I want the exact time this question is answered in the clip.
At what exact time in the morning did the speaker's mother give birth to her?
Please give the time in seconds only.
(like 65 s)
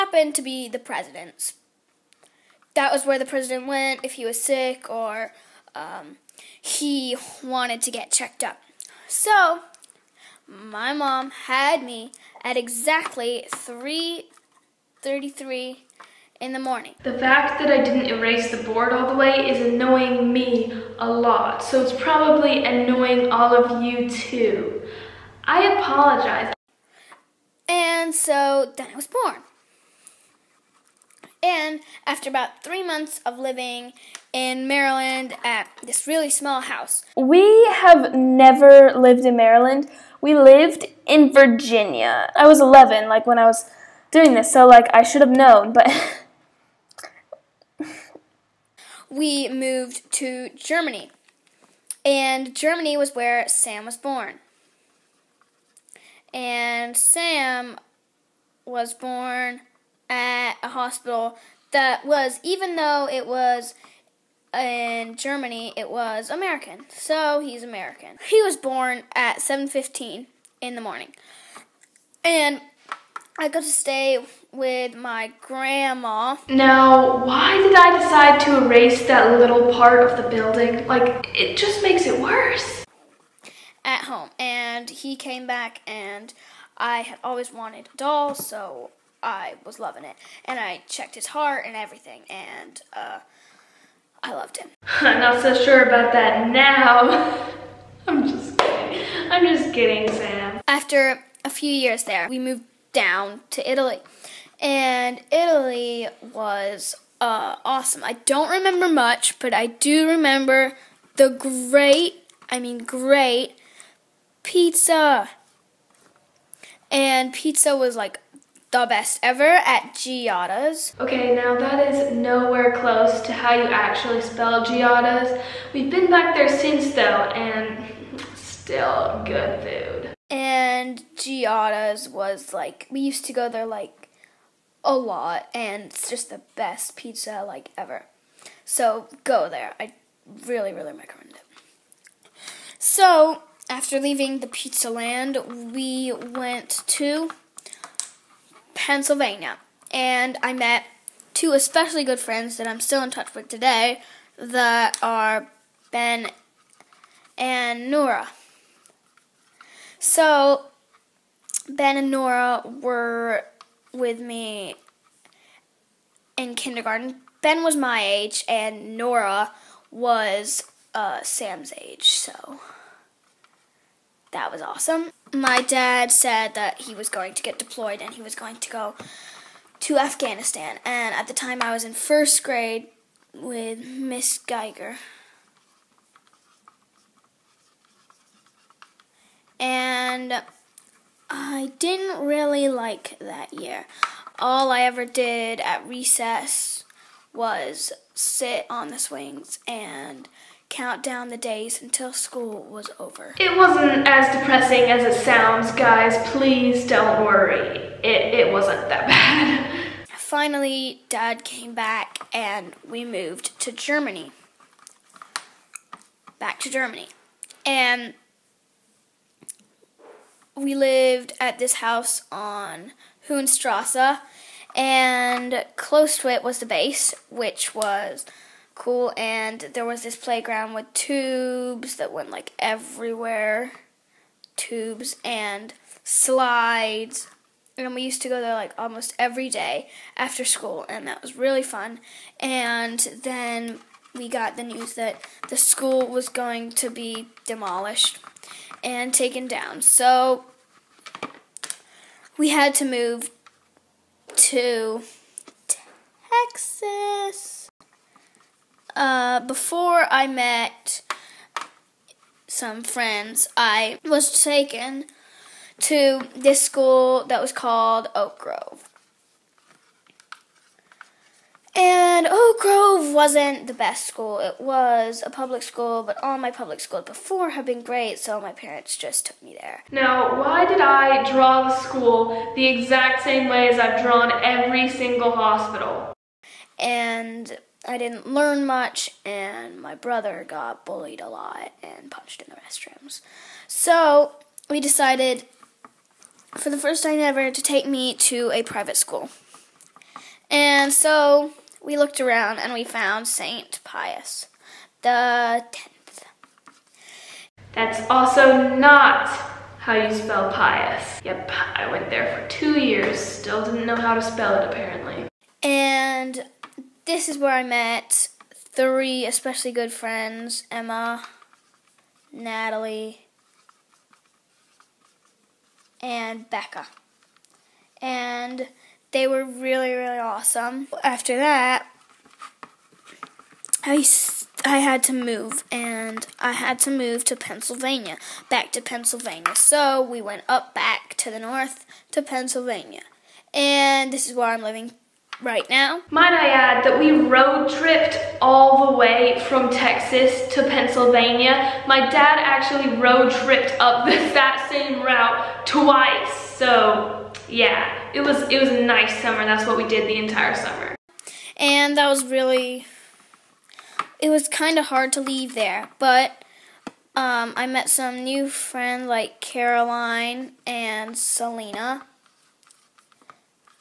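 13 s.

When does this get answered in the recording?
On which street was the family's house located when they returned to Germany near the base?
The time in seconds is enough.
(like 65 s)
223 s.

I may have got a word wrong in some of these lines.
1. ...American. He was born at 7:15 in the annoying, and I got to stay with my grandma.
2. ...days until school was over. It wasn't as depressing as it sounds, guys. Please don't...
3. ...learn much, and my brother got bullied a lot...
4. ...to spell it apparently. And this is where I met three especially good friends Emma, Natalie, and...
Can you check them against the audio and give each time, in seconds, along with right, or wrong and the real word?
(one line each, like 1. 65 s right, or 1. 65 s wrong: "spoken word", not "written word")
1. 67 s wrong: "morning", not "annoying"
2. 201 s right
3. 288 s right
4. 314 s right.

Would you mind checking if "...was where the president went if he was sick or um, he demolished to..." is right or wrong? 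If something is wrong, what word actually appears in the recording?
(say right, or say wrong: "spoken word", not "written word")
wrong: "wanted", not "demolished".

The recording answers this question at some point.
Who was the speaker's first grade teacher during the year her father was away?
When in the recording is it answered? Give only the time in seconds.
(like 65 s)
183 s.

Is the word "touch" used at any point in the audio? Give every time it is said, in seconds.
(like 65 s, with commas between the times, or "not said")
153 s.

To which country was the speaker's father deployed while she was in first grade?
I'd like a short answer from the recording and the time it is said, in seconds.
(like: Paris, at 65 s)
Afghanistan, at 179 s.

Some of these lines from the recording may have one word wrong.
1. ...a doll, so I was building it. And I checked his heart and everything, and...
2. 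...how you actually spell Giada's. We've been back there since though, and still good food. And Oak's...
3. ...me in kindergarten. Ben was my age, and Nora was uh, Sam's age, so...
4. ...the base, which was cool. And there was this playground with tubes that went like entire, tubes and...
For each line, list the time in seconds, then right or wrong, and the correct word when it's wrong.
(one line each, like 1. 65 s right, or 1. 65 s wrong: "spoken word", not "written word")
1. 87 s wrong: "loving", not "building"
2. 123 s wrong: "Giada", not "Oak"
3. 164 s right
4. 226 s wrong: "everywhere", not "entire".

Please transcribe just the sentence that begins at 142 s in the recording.
So after leaving the pizza land, we went to Pennsylvania.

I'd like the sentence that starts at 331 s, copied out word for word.
After that, I, I had to move, and I had to move to Pennsylvania, back to Pennsylvania.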